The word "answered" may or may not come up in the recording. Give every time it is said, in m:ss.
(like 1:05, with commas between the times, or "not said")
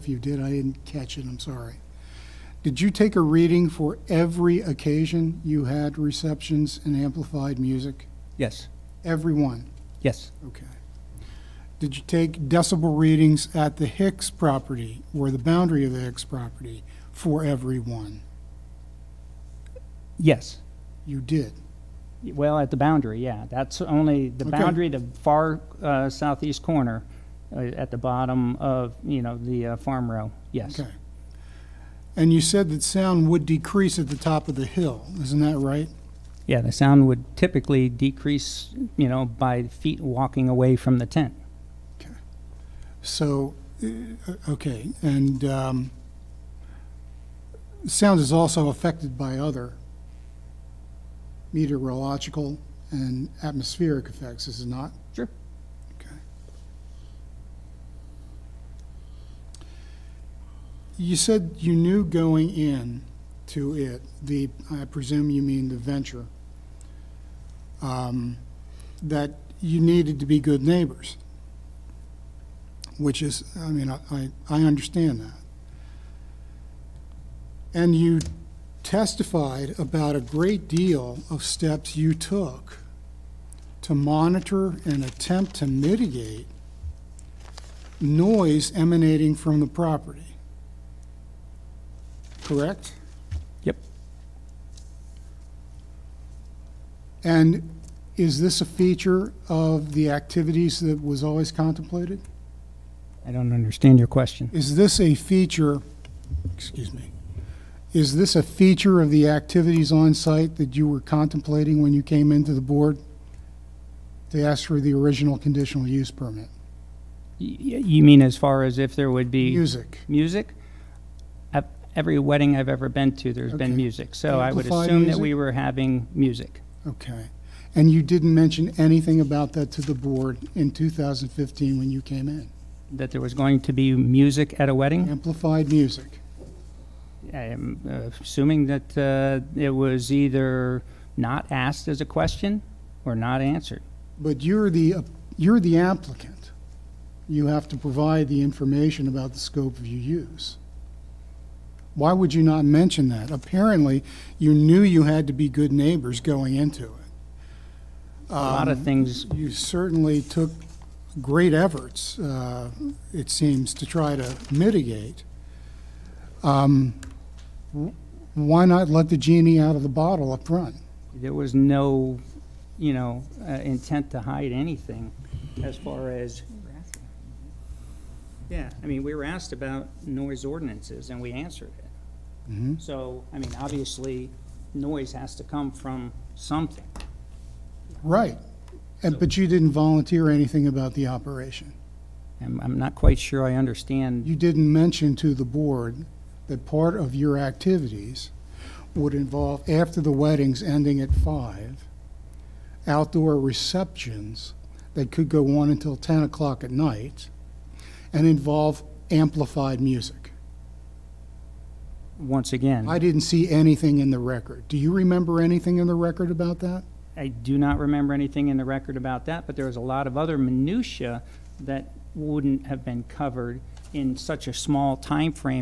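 2:23, 3:01.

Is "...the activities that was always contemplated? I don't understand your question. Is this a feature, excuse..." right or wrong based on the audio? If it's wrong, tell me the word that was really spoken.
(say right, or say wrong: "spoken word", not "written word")
right.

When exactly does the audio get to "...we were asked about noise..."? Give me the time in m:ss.
2:59.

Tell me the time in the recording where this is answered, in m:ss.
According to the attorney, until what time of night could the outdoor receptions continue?
3:25.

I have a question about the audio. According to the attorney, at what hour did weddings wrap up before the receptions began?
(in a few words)
5.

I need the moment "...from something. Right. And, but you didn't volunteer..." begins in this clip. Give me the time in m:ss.
3:05.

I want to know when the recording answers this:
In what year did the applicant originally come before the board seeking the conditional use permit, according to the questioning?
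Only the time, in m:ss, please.
2:10.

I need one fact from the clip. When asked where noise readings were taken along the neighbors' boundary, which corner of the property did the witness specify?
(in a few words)
southeast corner.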